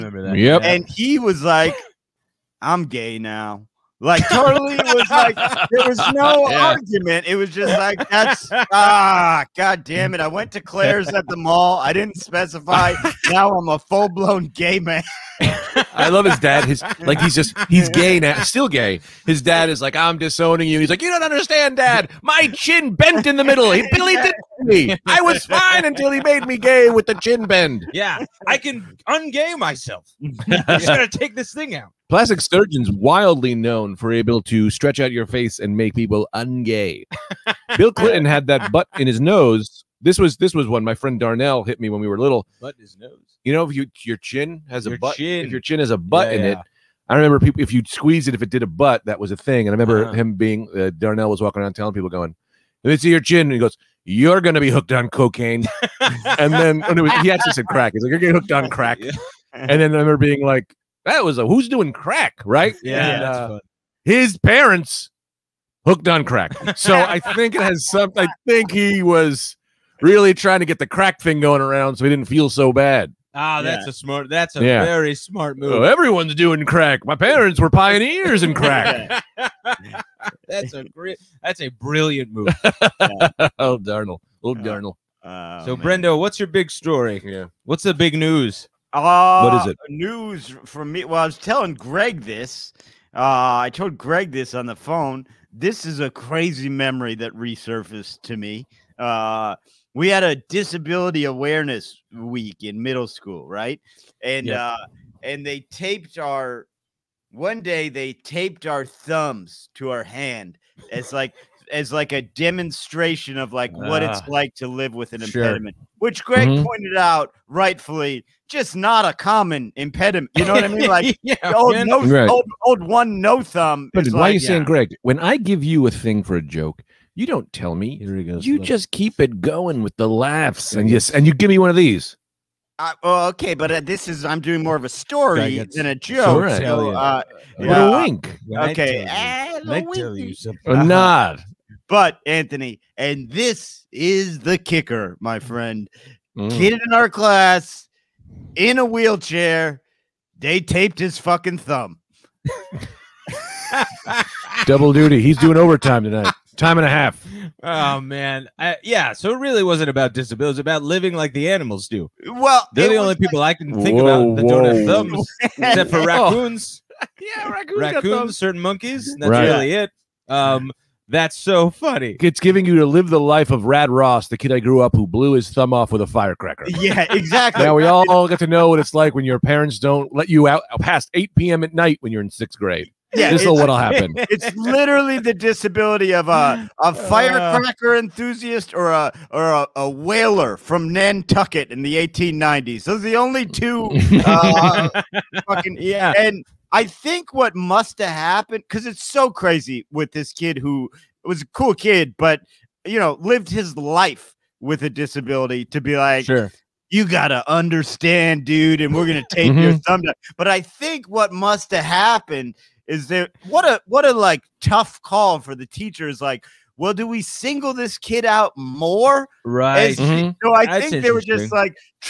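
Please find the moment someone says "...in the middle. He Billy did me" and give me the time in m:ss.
0:23.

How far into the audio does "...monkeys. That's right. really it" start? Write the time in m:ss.
2:48.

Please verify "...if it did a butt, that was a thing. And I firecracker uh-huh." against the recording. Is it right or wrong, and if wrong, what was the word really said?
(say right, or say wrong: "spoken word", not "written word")
wrong: "remember", not "firecracker".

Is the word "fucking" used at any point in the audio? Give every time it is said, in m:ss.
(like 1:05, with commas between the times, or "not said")
2:31, 3:15.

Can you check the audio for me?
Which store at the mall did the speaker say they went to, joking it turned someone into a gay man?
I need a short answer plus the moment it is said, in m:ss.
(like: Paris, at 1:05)
Claire's, at 0:10.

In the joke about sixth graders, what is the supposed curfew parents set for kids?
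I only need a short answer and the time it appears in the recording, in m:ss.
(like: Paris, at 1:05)
8 p.m., at 3:01.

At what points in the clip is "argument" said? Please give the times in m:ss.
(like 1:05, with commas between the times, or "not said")
0:06.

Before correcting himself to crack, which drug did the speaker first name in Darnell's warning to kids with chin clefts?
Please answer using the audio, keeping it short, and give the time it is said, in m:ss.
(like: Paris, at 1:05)
cocaine, at 0:55.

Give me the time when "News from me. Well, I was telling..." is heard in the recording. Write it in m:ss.
1:29.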